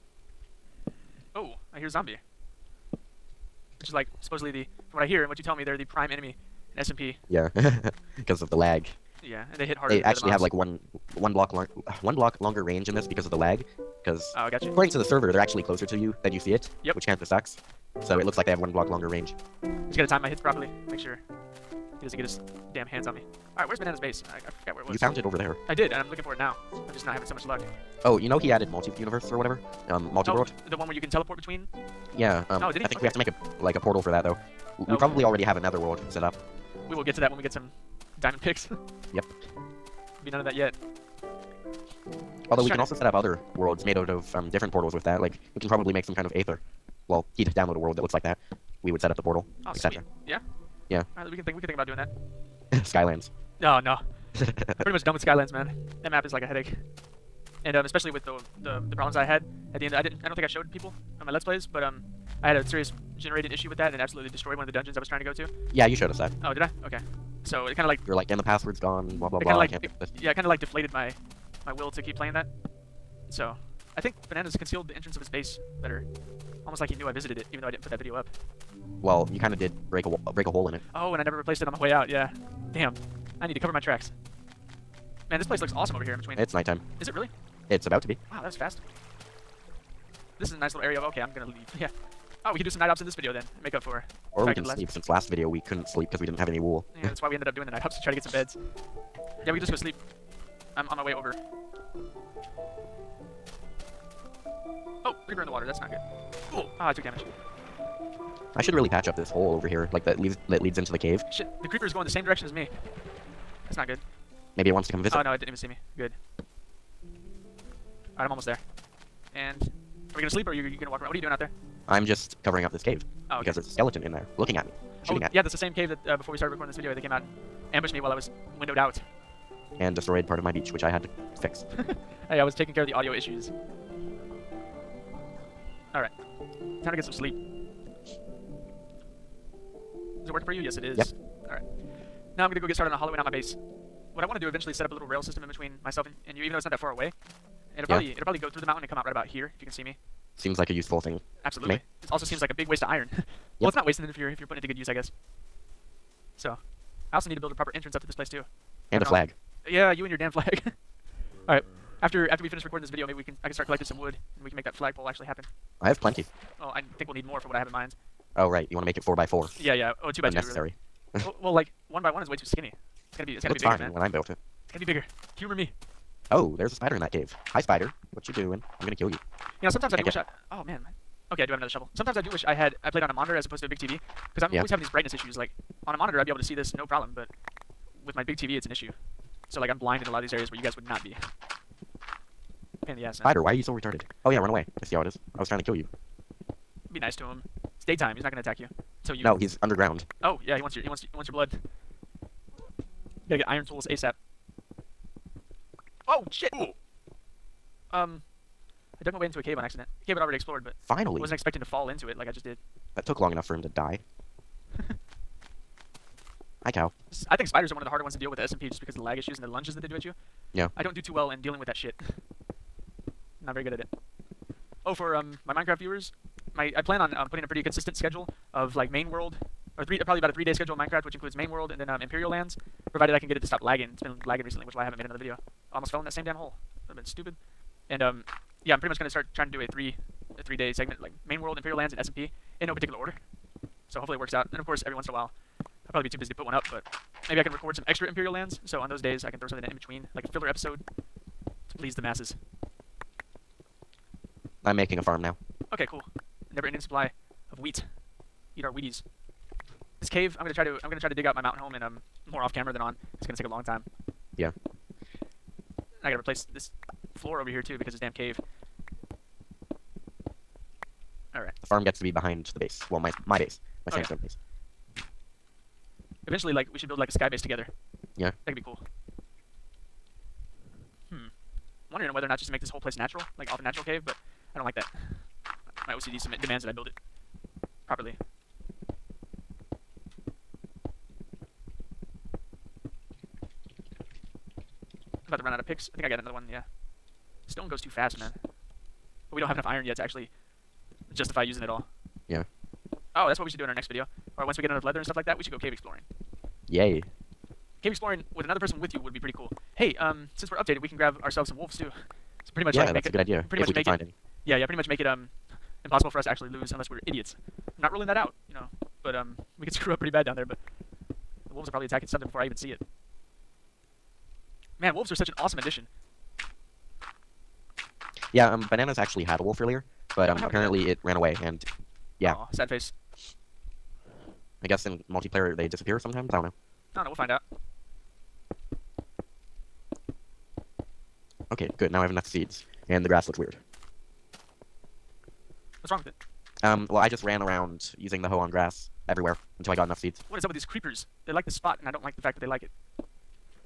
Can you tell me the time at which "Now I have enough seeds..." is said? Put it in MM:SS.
05:41.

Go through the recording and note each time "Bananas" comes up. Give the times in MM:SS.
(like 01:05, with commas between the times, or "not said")
00:23, 01:14, 05:28.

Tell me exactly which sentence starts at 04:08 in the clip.
So on those days, I can throw something in between, like a filler episode, to please the masses.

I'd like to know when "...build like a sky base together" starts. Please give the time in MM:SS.
04:36.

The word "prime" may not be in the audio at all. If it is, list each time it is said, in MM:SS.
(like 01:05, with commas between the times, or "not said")
00:05.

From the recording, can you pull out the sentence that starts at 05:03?
Oh, that's what we should do in our next video.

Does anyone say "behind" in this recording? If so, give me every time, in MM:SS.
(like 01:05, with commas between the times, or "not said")
04:32.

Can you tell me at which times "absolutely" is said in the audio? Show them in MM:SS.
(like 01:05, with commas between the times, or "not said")
01:03, 02:31.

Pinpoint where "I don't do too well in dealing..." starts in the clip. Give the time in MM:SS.
03:40.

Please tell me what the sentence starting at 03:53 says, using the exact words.
It's been lagging recently, which is why I haven't made another video.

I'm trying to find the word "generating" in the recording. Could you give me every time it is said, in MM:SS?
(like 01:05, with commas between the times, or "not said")
01:03.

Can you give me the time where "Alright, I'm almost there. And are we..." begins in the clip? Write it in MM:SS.
01:58.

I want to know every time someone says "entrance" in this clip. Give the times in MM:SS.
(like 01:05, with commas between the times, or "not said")
01:14, 02:37.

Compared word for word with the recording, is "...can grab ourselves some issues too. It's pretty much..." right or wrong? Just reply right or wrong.
wrong.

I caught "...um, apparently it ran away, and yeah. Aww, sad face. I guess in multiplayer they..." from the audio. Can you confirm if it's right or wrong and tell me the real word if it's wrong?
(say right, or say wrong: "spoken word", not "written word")
right.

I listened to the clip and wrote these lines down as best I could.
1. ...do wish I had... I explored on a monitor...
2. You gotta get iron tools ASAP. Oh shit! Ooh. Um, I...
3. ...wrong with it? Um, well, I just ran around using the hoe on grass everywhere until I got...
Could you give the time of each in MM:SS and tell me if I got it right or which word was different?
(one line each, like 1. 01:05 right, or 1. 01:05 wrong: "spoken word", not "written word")
1. 03:02 wrong: "played", not "explored"
2. 03:22 right
3. 05:45 right.